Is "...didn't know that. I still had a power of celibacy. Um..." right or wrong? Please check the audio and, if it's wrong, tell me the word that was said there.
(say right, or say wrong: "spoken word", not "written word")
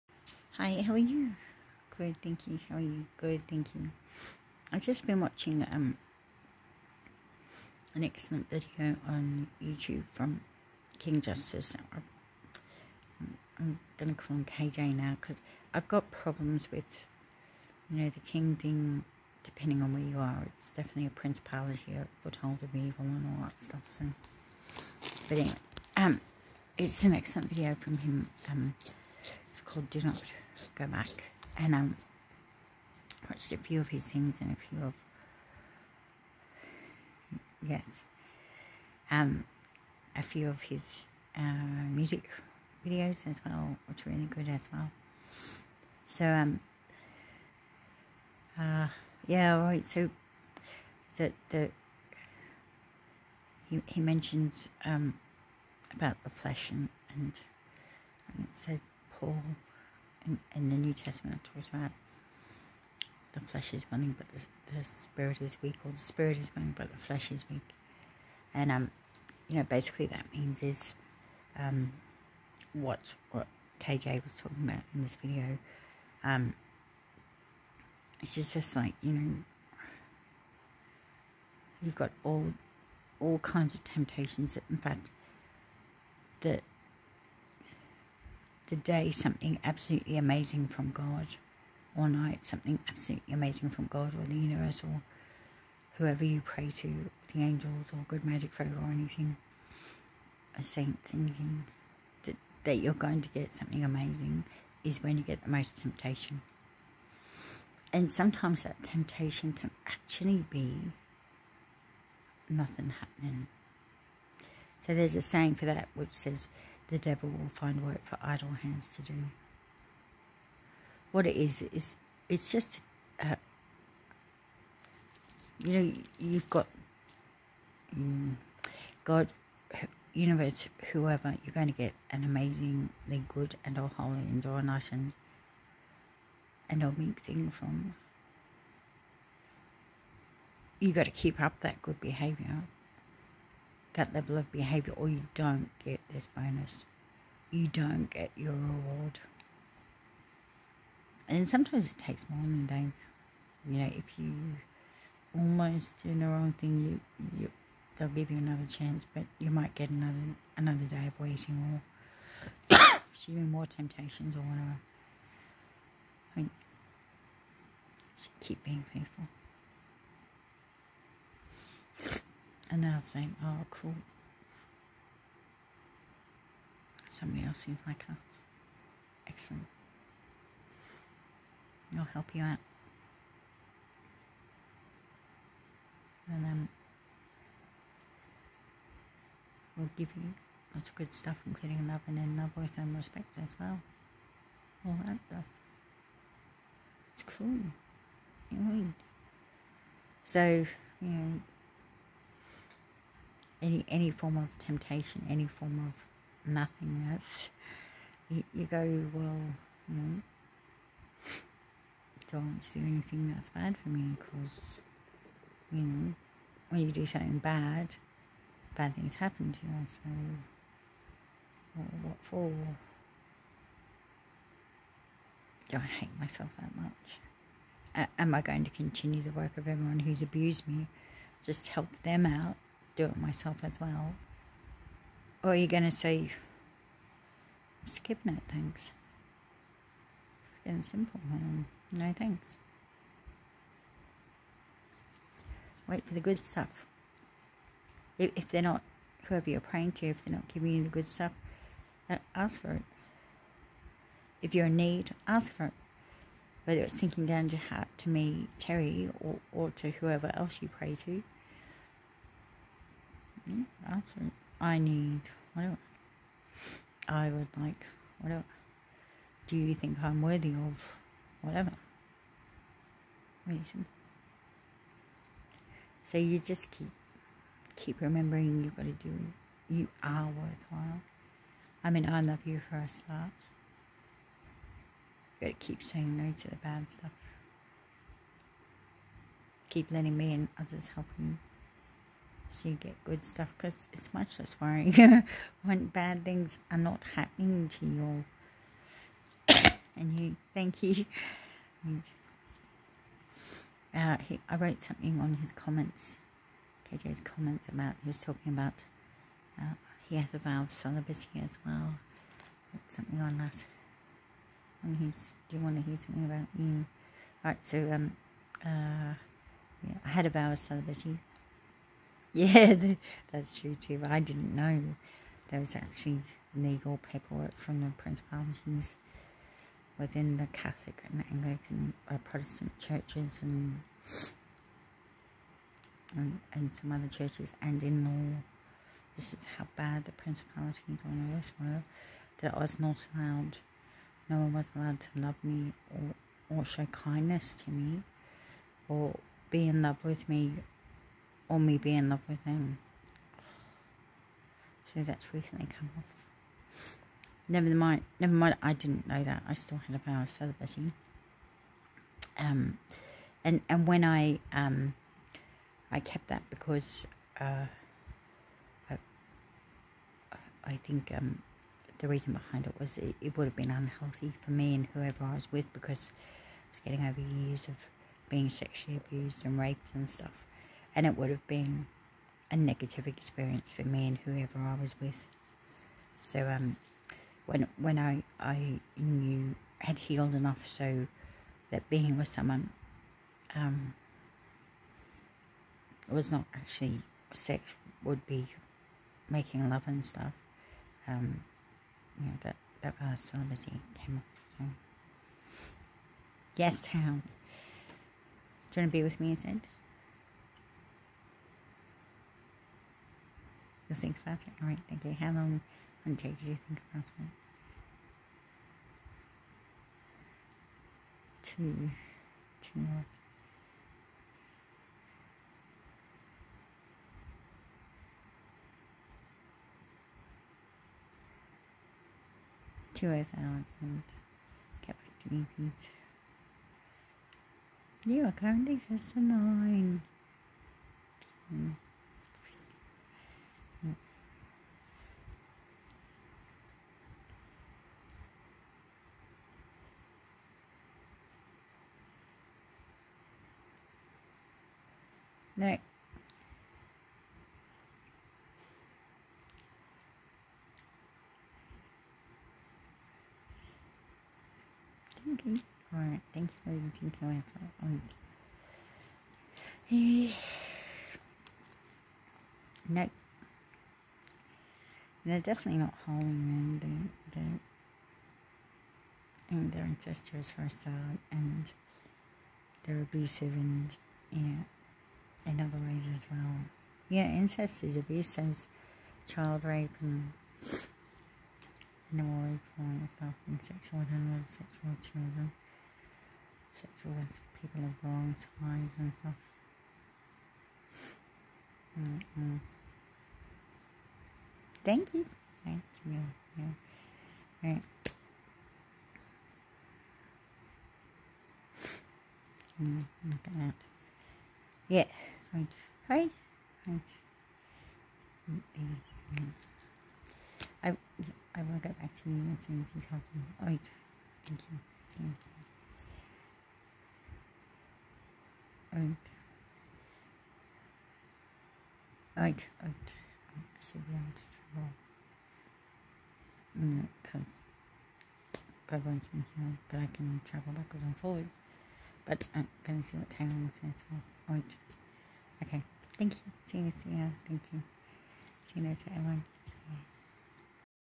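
right.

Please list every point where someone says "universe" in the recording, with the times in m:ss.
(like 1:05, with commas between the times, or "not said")
1:34, 2:10.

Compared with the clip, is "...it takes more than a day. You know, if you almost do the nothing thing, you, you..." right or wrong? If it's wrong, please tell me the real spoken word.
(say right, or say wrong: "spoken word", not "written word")
wrong: "wrong", not "nothing".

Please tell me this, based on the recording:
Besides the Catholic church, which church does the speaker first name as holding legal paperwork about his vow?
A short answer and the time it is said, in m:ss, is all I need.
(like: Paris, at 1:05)
Anglican, at 5:31.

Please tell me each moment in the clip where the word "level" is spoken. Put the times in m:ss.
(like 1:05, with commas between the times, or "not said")
2:24.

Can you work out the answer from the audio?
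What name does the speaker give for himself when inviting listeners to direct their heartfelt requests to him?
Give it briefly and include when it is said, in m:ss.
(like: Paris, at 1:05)
Terry, at 4:18.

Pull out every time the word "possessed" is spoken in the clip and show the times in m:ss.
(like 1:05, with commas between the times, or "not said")
not said.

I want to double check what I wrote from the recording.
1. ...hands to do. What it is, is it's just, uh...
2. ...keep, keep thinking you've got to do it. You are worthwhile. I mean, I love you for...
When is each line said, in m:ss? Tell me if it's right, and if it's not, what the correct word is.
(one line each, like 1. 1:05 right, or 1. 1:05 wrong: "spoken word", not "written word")
1. 1:58 right
2. 4:36 wrong: "remembering", not "thinking".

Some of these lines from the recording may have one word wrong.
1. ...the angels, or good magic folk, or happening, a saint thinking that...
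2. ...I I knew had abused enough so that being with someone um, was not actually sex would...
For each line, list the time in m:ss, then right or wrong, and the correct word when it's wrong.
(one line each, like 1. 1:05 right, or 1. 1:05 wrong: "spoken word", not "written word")
1. 1:37 wrong: "anything", not "happening"
2. 6:27 wrong: "healed", not "abused".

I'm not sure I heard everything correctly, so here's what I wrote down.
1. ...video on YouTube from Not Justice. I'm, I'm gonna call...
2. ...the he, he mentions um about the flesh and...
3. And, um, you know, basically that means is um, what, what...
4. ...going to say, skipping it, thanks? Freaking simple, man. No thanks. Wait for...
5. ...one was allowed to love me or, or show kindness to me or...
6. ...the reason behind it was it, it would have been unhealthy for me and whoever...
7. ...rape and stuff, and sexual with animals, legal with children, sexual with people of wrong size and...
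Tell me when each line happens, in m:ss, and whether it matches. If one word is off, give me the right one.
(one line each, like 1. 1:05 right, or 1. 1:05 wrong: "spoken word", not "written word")
1. 0:08 wrong: "King", not "Not"
2. 0:51 right
3. 1:08 right
4. 3:55 right
5. 5:44 right
6. 6:11 right
7. 8:12 wrong: "sexual", not "legal".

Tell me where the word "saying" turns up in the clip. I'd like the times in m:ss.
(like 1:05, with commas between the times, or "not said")
1:55, 4:45.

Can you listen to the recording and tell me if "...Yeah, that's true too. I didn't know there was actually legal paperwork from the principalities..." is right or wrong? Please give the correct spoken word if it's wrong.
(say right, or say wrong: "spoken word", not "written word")
right.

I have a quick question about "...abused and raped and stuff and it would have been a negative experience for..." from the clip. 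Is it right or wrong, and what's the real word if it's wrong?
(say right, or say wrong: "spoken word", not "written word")
right.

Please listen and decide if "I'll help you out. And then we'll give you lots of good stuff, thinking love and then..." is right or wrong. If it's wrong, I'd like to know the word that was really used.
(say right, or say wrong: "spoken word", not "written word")
wrong: "including", not "thinking".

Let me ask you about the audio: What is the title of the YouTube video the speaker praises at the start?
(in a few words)
Do Not.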